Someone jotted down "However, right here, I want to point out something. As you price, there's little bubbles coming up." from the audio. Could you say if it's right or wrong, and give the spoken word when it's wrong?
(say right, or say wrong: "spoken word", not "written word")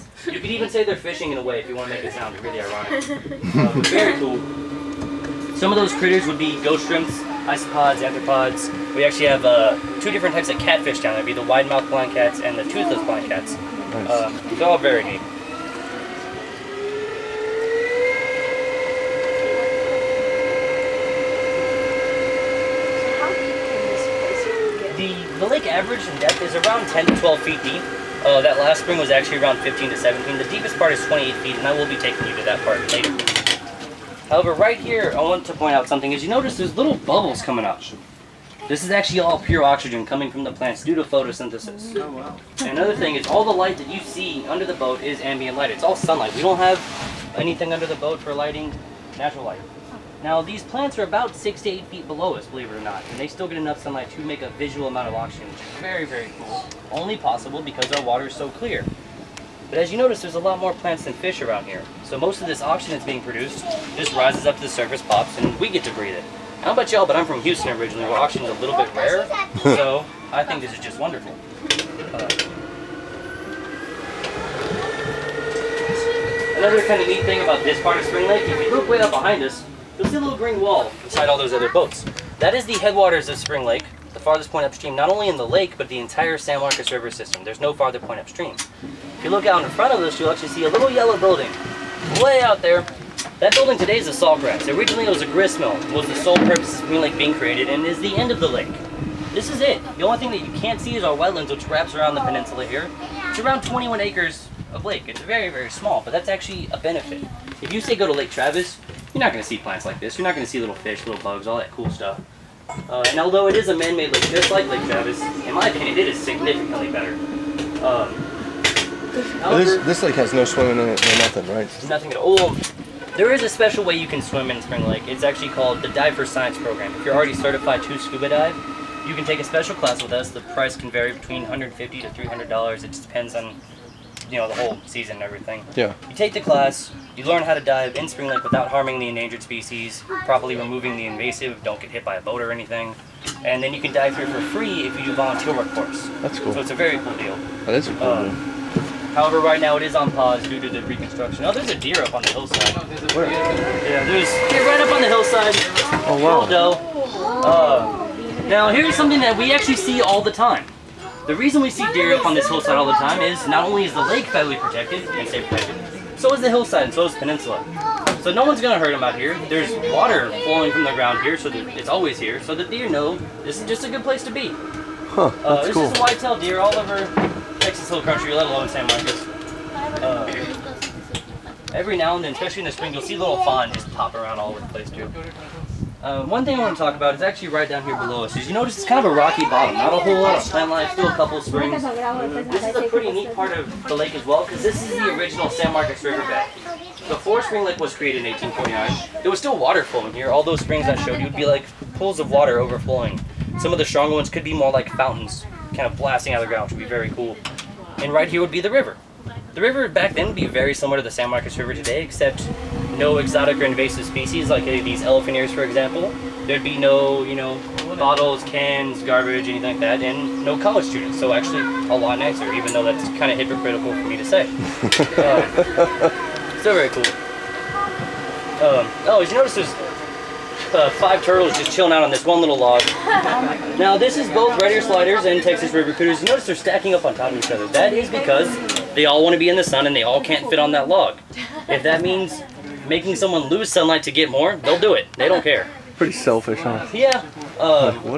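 wrong: "notice", not "price".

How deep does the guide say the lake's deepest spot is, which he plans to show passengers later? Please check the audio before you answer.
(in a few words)
28 feet.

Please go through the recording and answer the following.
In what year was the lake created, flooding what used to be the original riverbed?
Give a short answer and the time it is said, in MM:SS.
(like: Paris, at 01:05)
1849, at 03:18.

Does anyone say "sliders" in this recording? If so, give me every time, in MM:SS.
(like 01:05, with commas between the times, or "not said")
03:54.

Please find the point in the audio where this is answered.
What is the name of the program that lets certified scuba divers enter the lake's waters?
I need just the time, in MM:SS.
02:05.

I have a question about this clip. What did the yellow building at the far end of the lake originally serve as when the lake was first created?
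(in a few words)
grist mill.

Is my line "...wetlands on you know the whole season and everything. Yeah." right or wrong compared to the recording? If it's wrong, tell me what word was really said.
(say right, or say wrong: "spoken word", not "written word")
wrong: "depends", not "wetlands".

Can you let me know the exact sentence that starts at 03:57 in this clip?
That is because they all want to be in the sun and they all can't fit on that log.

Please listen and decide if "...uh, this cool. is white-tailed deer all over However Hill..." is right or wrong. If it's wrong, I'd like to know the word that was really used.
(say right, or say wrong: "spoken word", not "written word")
wrong: "Texas", not "However".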